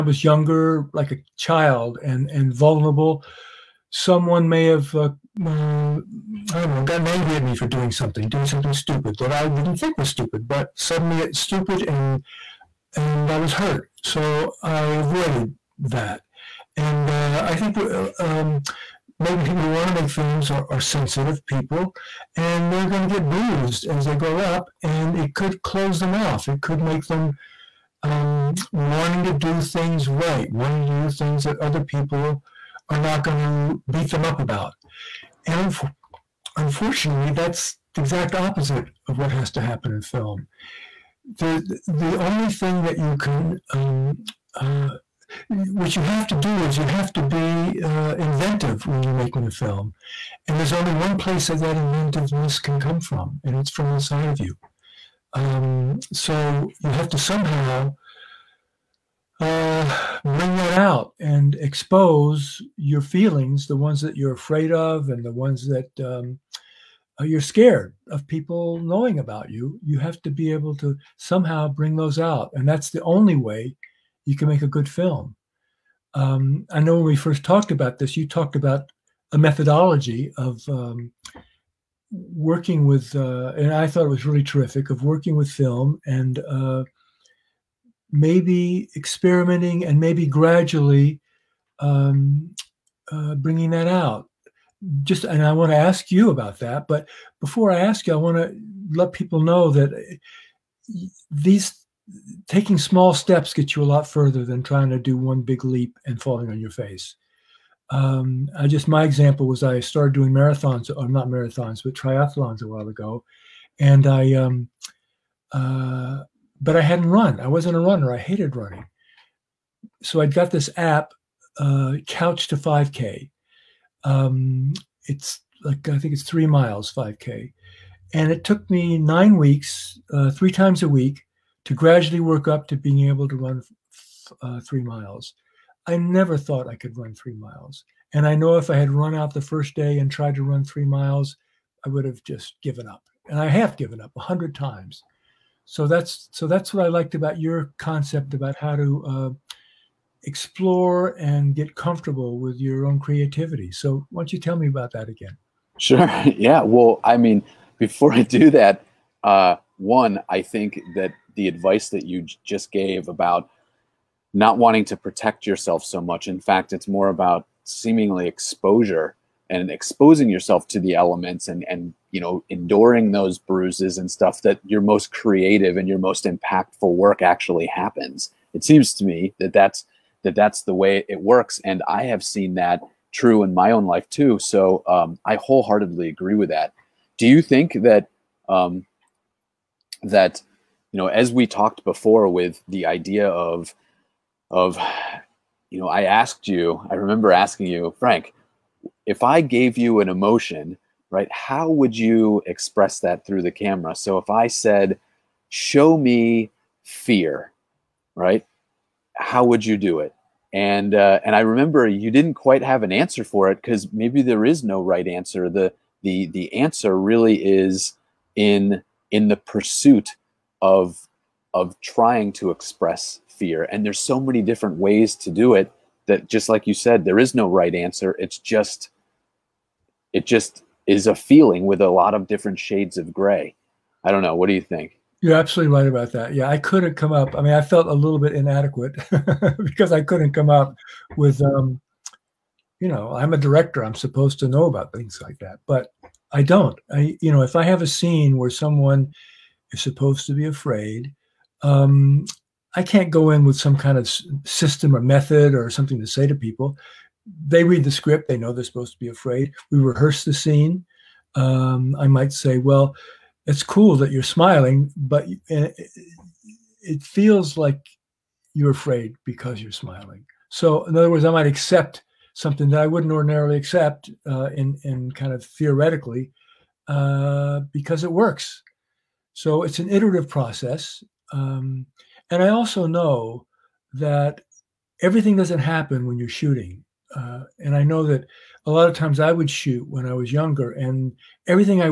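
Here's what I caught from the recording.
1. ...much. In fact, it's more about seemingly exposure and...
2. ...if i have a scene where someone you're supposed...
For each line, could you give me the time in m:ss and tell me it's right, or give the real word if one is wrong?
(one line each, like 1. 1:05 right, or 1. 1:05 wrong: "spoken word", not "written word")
1. 2:46 right
2. 4:07 right.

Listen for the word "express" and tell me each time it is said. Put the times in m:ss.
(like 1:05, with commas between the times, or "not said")
3:22, 3:42.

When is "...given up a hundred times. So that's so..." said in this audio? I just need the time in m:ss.
2:23.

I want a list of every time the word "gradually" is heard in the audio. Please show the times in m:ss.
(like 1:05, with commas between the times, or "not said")
1:30, 2:11.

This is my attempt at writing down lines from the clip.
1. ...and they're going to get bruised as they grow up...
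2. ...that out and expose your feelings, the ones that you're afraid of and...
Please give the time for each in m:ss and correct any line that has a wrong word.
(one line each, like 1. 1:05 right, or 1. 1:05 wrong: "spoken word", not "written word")
1. 0:22 right
2. 1:00 right.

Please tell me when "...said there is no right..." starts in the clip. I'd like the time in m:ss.
3:46.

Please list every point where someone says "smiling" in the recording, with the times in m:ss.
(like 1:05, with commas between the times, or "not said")
4:24, 4:29.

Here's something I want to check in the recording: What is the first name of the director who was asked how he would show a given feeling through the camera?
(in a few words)
Frank.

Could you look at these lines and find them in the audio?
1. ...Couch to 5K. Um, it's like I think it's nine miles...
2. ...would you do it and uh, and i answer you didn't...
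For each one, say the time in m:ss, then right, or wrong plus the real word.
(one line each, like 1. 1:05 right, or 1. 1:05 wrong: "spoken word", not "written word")
1. 2:02 wrong: "three", not "nine"
2. 3:29 wrong: "remember", not "answer".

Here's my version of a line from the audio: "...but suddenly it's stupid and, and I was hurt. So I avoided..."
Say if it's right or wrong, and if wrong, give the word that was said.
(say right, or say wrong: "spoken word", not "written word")
right.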